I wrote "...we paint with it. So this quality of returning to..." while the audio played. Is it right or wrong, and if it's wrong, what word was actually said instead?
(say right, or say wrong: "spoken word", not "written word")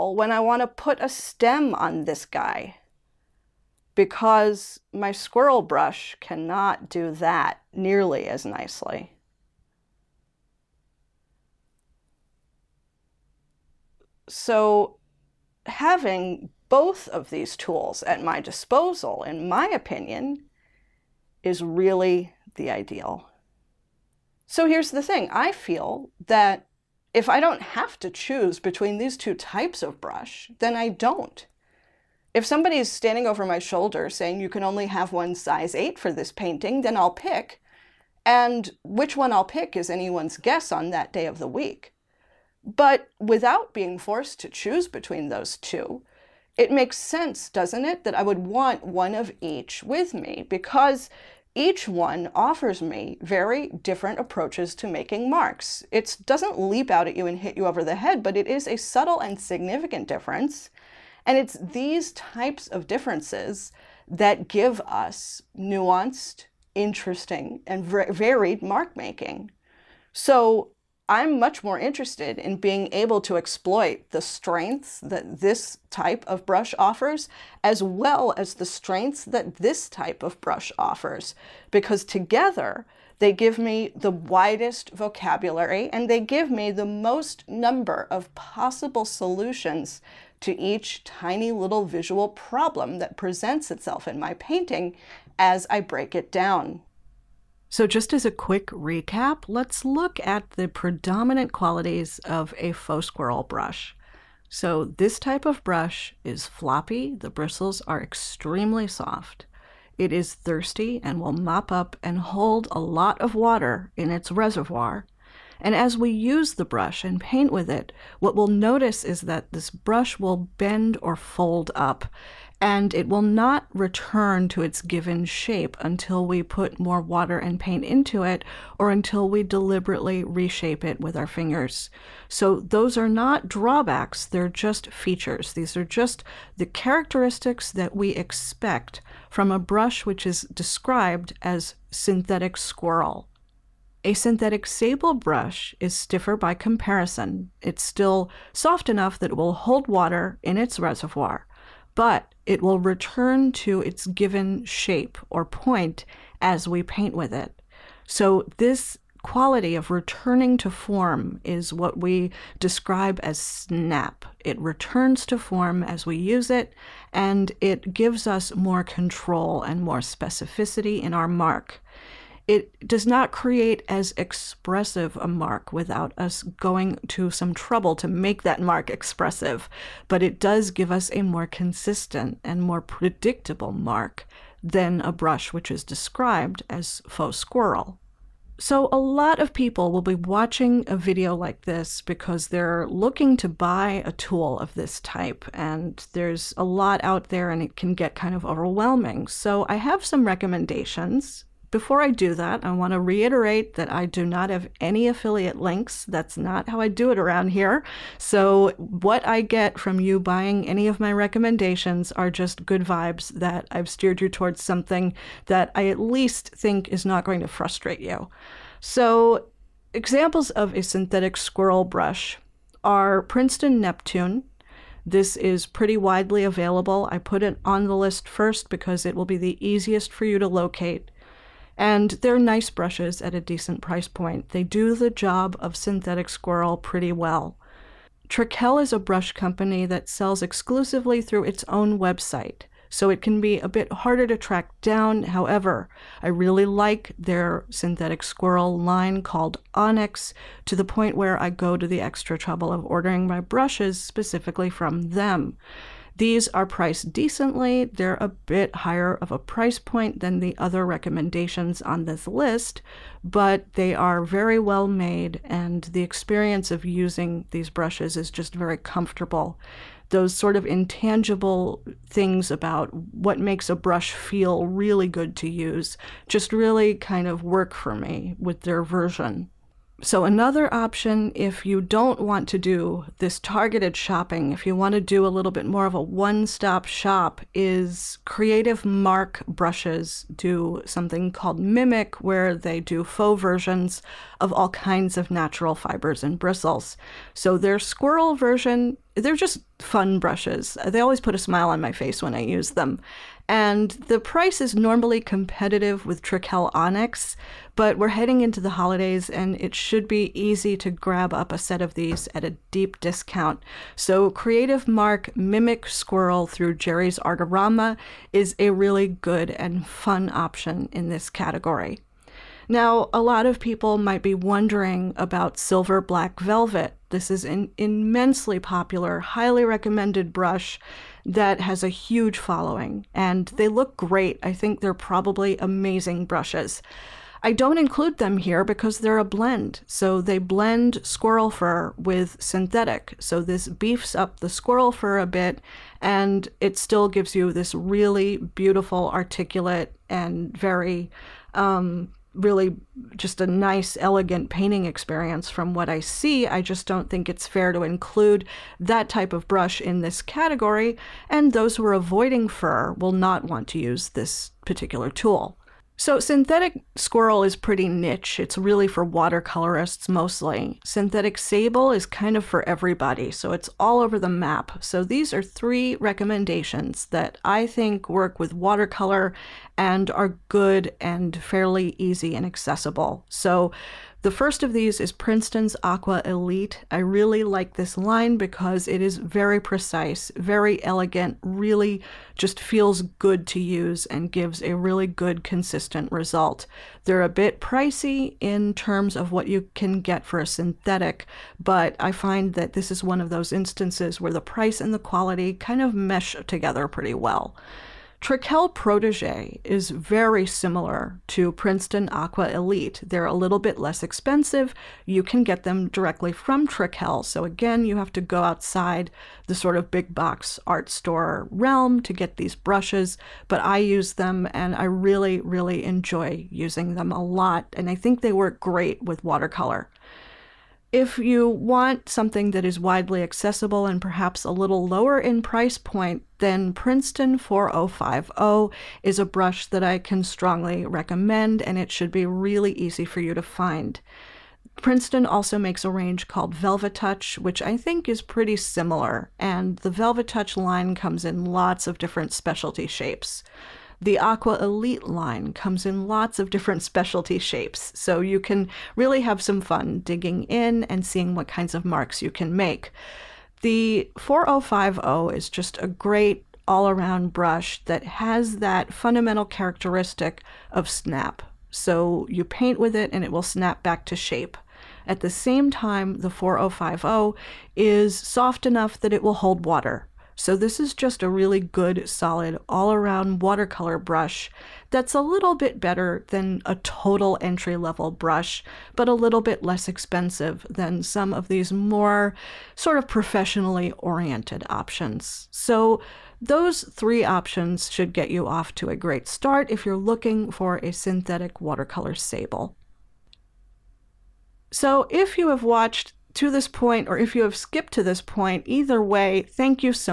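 right.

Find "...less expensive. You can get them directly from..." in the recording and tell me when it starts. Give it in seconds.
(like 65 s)
413 s.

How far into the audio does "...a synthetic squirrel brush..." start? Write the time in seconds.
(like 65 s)
220 s.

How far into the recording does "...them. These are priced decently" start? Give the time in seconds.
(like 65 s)
255 s.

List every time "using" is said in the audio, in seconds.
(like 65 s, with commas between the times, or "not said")
266 s, 426 s.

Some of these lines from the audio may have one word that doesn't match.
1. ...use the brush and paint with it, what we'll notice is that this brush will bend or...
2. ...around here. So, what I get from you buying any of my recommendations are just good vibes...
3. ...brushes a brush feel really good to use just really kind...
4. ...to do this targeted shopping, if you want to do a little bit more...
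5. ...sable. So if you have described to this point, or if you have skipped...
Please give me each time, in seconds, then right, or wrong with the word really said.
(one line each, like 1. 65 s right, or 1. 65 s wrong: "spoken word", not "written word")
1. 116 s right
2. 207 s right
3. 273 s wrong: "makes", not "brushes"
4. 282 s right
5. 502 s wrong: "watched", not "described".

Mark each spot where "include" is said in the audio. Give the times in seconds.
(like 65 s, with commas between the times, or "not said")
337 s, 357 s.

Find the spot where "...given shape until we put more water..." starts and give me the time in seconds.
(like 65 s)
124 s.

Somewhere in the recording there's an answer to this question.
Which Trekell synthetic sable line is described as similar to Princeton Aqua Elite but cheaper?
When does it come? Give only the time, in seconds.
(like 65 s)
408 s.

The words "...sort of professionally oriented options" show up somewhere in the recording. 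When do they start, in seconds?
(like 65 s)
492 s.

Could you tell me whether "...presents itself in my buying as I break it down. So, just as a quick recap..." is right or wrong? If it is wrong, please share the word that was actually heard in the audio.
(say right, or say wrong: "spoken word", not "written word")
wrong: "painting", not "buying".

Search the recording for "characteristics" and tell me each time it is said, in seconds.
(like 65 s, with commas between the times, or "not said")
136 s, 469 s.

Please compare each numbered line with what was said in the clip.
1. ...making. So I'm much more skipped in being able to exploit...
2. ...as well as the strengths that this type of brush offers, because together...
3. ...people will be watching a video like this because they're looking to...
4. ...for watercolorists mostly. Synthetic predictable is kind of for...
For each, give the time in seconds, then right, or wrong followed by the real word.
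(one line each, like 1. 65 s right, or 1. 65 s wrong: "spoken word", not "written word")
1. 68 s wrong: "interested", not "skipped"
2. 77 s right
3. 189 s right
4. 368 s wrong: "sable", not "predictable".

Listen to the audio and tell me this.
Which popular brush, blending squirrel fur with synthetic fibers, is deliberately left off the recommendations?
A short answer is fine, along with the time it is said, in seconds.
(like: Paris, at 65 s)
Silver Black Velvet, at 325 s.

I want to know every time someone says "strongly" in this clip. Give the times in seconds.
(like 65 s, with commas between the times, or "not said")
440 s.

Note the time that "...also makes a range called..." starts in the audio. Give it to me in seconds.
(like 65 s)
445 s.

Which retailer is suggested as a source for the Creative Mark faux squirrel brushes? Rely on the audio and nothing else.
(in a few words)
Jerry's Artorama.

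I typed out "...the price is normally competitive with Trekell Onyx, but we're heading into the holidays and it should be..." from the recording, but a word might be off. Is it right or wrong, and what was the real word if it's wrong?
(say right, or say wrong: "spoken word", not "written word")
right.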